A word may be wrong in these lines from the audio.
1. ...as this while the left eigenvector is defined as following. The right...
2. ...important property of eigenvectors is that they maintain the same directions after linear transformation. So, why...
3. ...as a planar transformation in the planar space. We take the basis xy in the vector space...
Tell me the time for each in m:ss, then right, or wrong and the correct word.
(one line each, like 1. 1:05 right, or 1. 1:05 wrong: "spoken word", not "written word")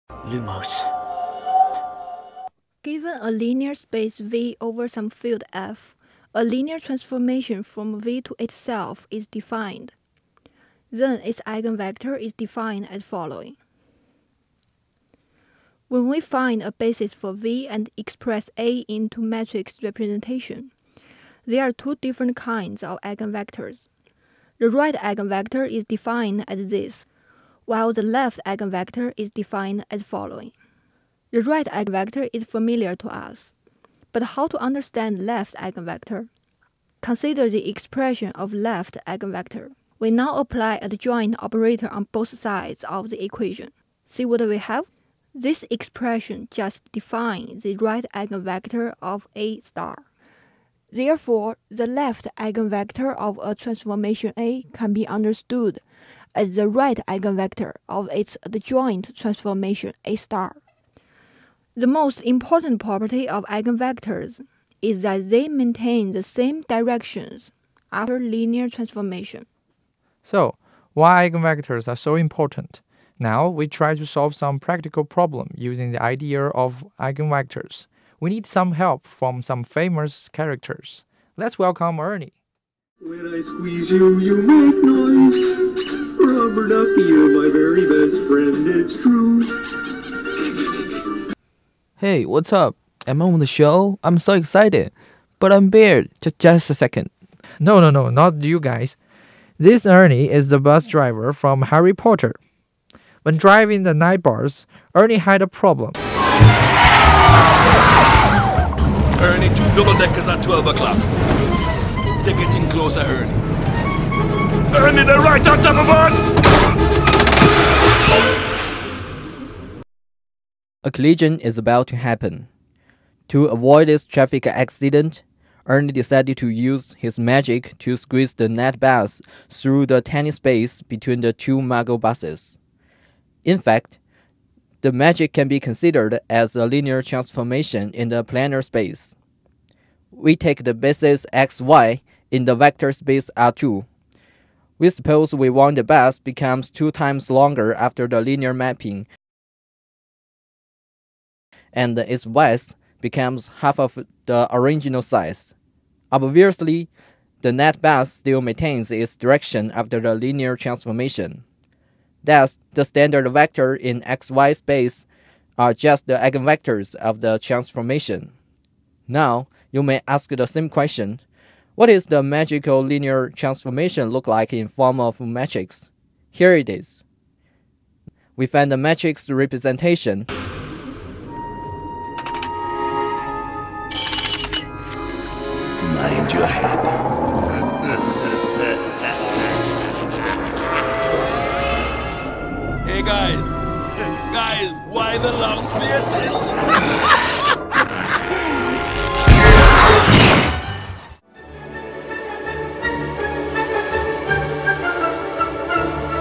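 1. 0:26 right
2. 1:02 right
3. 2:16 wrong: "linear", not "planar".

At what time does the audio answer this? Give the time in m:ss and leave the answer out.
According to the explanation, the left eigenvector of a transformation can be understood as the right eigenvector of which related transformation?
0:58.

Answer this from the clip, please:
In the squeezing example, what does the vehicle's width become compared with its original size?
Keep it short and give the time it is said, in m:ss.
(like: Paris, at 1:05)
half, at 2:33.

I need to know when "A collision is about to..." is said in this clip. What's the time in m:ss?
2:00.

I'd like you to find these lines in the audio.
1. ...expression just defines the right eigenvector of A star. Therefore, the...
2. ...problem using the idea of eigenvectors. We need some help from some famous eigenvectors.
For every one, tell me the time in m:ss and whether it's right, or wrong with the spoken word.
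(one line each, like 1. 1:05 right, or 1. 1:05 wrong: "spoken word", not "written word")
1. 0:45 right
2. 1:15 wrong: "characters", not "eigenvectors".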